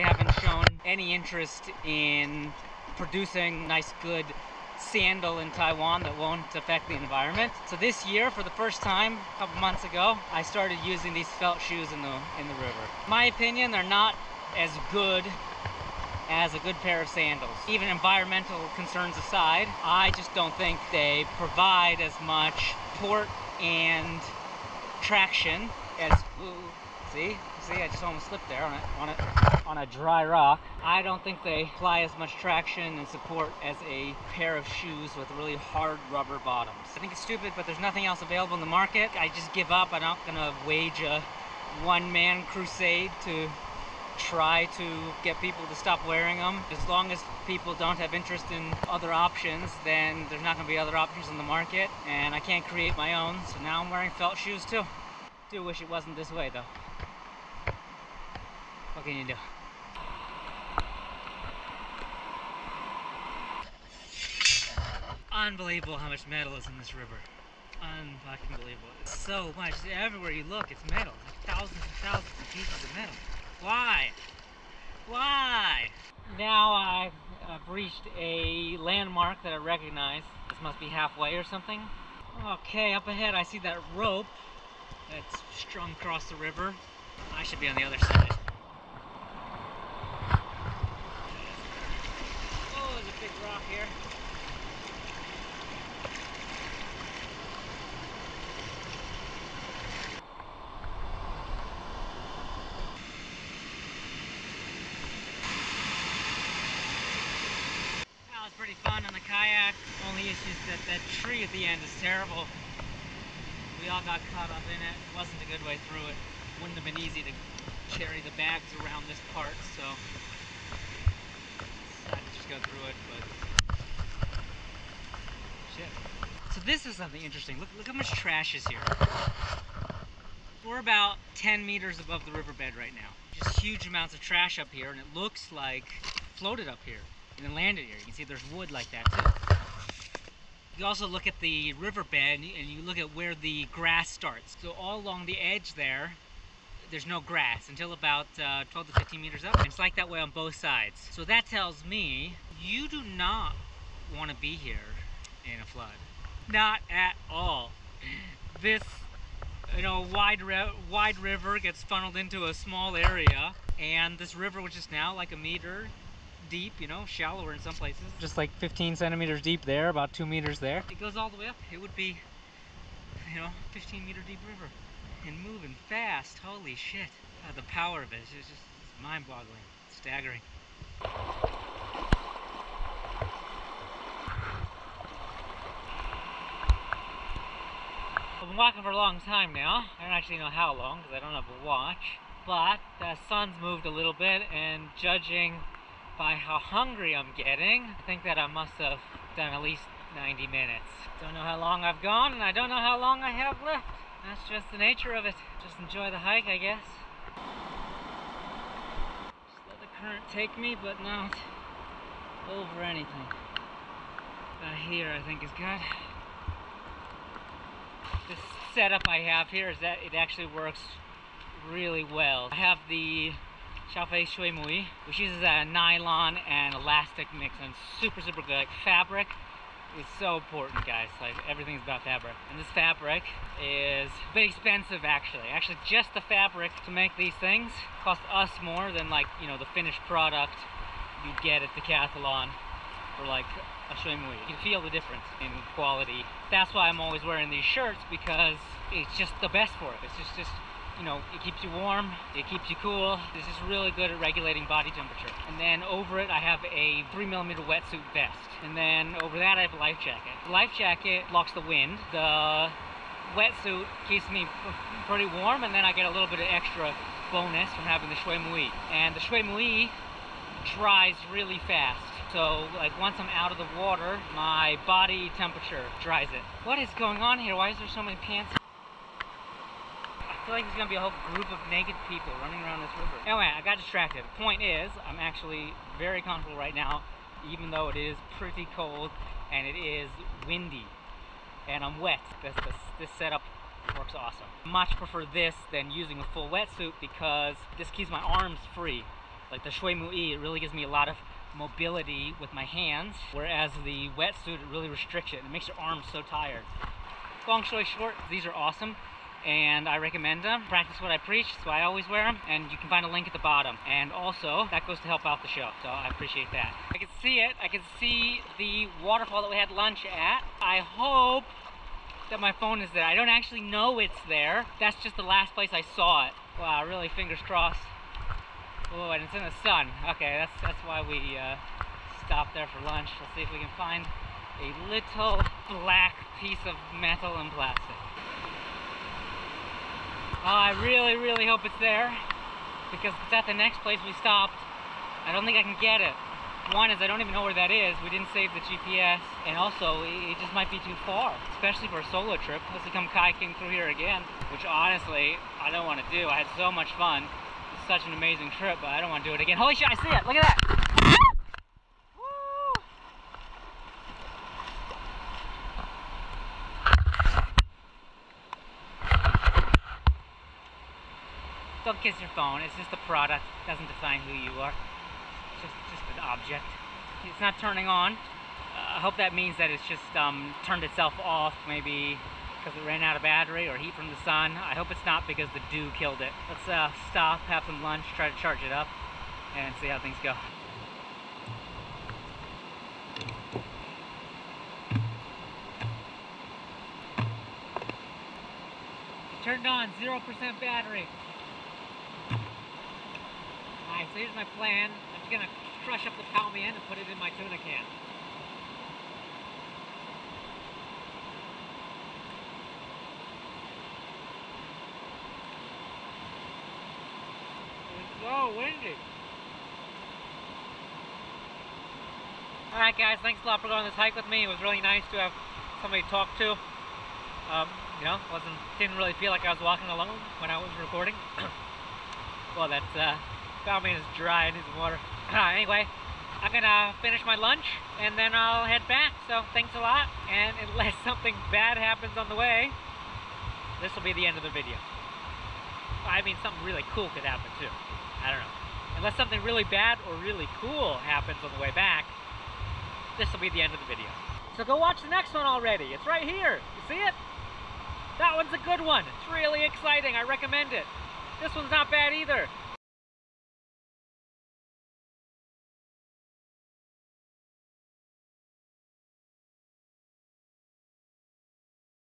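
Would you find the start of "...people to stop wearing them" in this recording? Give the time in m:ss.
0:45.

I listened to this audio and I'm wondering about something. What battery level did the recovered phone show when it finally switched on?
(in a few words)
0%.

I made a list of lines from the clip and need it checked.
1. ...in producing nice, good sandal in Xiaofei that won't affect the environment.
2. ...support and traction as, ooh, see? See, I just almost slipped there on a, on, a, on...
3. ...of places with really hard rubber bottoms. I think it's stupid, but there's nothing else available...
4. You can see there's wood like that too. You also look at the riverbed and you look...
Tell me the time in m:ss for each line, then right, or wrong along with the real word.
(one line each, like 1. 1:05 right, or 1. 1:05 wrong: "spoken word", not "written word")
1. 0:01 wrong: "Taiwan", not "Xiaofei"
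2. 0:22 right
3. 0:34 wrong: "shoes", not "places"
4. 2:17 right.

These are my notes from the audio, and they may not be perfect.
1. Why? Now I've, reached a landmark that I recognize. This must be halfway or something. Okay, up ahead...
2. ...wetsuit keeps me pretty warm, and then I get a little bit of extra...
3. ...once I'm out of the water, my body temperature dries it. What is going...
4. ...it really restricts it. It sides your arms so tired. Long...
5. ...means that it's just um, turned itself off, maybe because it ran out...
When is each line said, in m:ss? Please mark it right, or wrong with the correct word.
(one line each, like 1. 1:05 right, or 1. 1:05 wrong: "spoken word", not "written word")
1. 1:15 right
2. 4:23 right
3. 4:33 right
4. 5:04 wrong: "makes", not "sides"
5. 6:19 right.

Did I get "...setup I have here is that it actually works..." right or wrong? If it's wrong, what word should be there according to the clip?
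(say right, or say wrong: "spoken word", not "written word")
right.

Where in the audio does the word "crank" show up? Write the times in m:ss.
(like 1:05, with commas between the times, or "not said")
not said.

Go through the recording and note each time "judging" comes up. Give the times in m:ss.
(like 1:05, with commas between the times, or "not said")
3:15.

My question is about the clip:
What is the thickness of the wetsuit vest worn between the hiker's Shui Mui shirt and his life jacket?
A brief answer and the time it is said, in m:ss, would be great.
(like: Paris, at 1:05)
3 millimeters, at 4:17.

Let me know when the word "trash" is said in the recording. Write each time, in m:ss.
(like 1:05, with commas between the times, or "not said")
2:08, 2:14.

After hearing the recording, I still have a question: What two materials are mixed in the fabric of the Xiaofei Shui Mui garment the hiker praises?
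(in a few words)
Nylon and elastic.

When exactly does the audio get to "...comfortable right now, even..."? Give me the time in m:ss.
4:46.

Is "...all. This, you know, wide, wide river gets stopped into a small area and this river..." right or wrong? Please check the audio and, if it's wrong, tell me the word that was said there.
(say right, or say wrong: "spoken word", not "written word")
wrong: "funneled", not "stopped".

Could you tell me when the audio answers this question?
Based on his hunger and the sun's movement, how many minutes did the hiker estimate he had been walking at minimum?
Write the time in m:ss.
3:20.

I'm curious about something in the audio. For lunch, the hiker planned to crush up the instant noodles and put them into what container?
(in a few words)
Tuna can.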